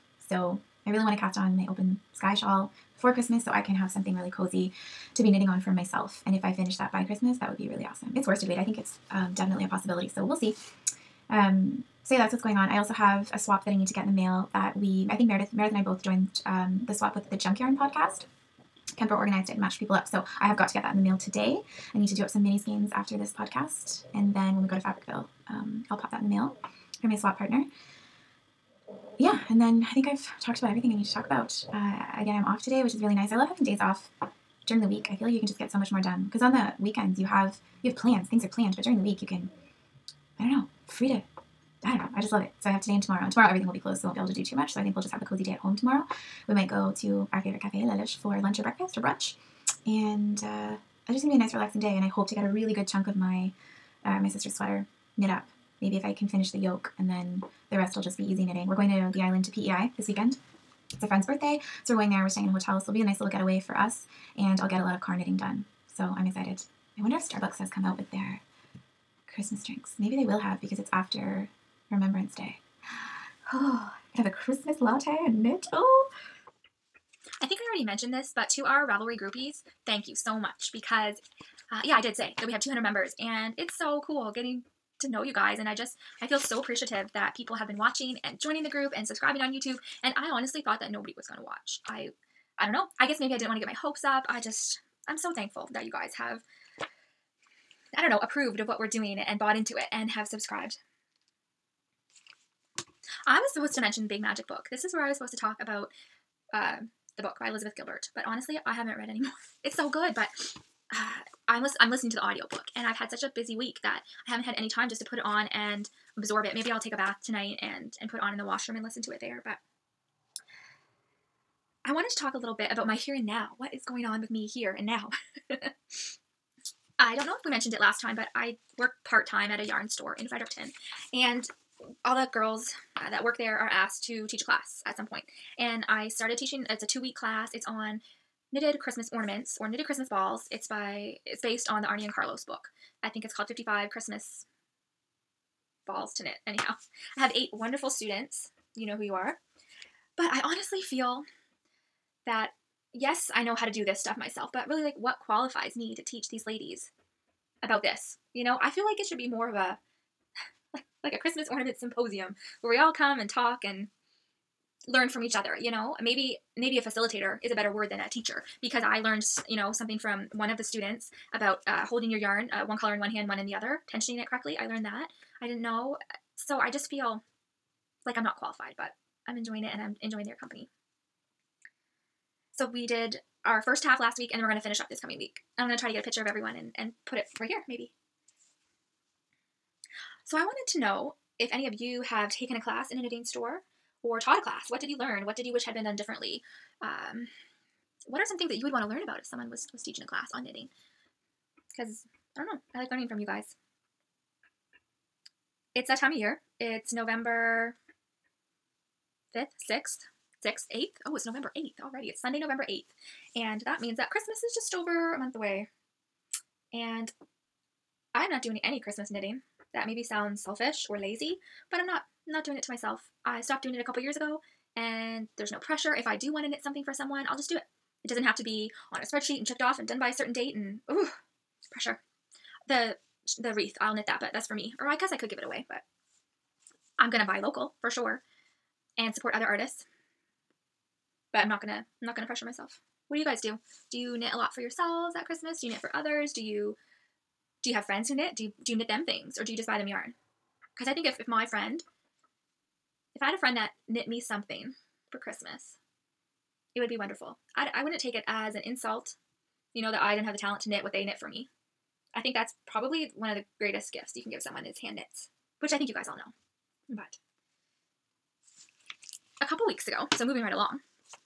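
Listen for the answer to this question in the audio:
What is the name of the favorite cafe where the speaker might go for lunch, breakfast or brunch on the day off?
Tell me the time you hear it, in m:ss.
0:47.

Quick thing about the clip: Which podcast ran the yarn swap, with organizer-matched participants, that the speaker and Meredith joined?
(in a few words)
Junk Yarn.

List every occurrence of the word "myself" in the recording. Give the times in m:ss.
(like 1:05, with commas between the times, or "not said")
0:05, 2:34, 3:42, 4:02.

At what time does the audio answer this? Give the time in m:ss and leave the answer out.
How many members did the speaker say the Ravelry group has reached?
1:22.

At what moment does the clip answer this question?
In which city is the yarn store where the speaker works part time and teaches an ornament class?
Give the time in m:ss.
2:10.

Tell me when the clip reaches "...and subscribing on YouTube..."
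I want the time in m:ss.
1:28.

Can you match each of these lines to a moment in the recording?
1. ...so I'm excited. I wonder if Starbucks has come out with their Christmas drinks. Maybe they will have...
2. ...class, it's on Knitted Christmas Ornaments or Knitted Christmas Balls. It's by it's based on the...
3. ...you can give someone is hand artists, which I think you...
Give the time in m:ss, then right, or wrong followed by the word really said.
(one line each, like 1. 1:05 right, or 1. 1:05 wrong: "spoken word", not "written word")
1. 1:05 right
2. 2:17 right
3. 4:24 wrong: "knits", not "artists".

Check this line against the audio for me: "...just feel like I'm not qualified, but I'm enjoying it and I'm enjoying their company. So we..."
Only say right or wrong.
right.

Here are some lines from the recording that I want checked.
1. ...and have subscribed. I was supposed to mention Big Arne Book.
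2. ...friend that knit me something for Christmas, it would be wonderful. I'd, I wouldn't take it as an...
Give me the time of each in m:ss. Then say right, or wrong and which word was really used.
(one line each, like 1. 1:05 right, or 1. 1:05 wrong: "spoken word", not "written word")
1. 1:39 wrong: "Magic", not "Arne"
2. 4:13 right.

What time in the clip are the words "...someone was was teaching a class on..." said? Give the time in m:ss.
3:19.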